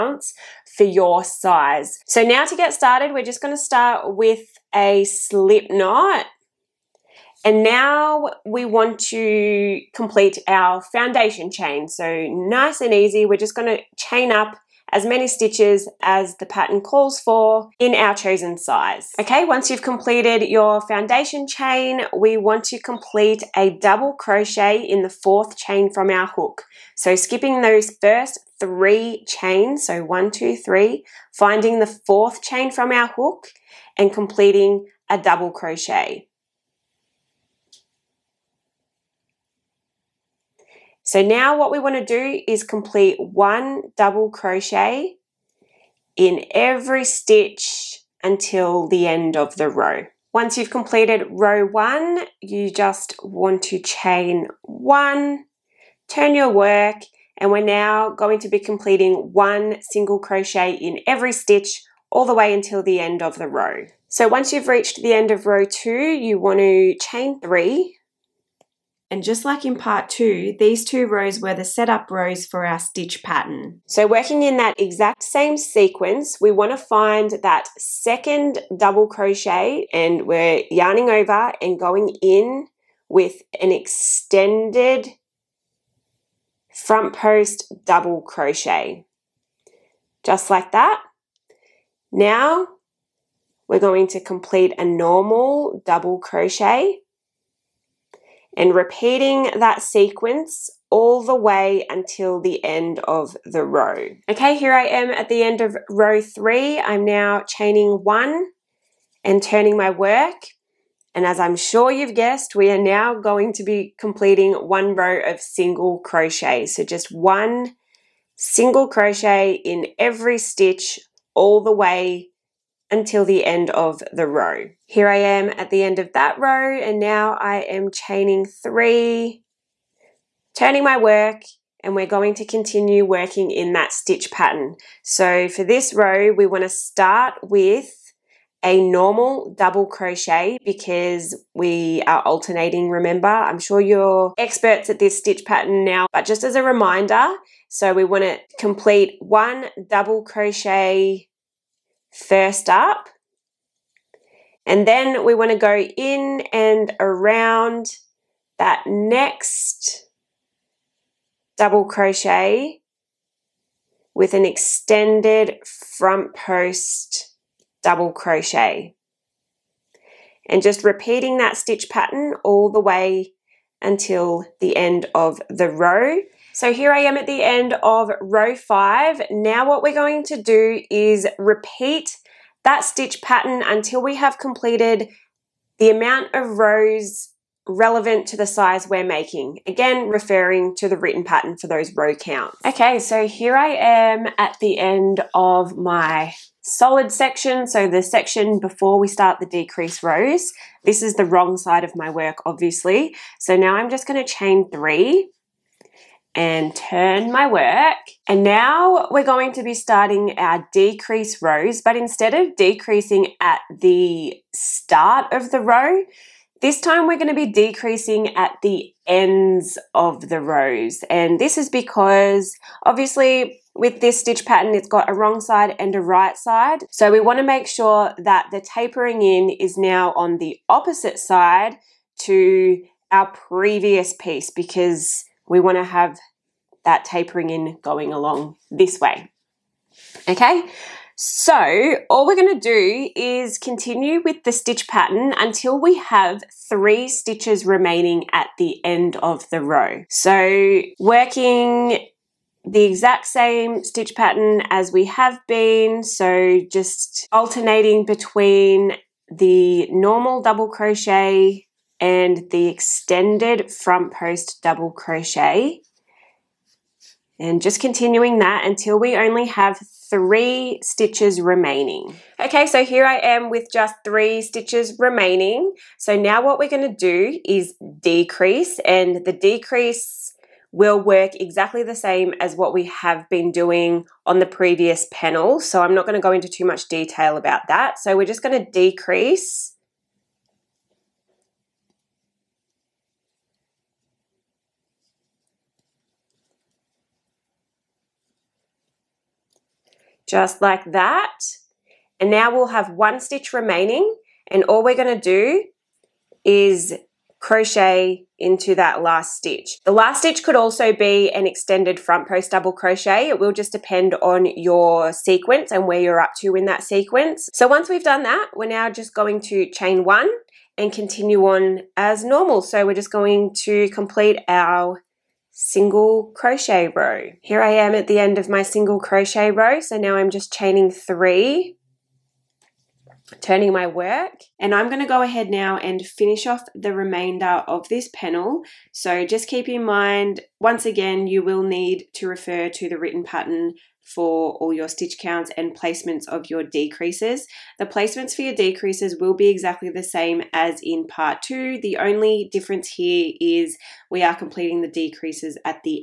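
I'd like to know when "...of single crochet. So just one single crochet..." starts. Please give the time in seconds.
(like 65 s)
115 s.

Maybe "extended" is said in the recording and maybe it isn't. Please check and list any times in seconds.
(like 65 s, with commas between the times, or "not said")
83 s, 164 s, 262 s, 311 s.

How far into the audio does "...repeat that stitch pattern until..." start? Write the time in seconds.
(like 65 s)
181 s.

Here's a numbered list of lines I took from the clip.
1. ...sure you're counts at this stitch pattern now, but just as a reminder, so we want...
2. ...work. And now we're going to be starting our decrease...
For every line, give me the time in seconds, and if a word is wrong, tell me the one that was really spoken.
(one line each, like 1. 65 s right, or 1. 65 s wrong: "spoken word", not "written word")
1. 143 s wrong: "experts", not "counts"
2. 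207 s right.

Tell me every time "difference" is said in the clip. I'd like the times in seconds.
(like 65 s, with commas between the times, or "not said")
352 s.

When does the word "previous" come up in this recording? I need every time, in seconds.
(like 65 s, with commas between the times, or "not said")
233 s, 284 s.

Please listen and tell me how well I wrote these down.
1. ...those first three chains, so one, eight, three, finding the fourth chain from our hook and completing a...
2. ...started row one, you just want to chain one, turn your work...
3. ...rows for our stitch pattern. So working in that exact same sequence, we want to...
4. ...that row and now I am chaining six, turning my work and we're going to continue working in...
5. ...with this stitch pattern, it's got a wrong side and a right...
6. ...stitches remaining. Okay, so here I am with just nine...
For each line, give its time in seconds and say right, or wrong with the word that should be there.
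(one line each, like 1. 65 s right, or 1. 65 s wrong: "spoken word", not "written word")
1. 27 s wrong: "two", not "eight"
2. 50 s wrong: "completed", not "started"
3. 72 s right
4. 126 s wrong: "three", not "six"
5. 223 s right
6. 270 s wrong: "three", not "nine".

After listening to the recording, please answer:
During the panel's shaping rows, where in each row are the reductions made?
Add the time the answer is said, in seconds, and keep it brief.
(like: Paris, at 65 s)
at the ends, at 219 s.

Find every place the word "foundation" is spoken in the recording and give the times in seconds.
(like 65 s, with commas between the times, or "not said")
10 s, 20 s.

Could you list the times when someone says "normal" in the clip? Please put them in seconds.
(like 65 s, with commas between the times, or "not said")
94 s, 138 s, 259 s, 322 s.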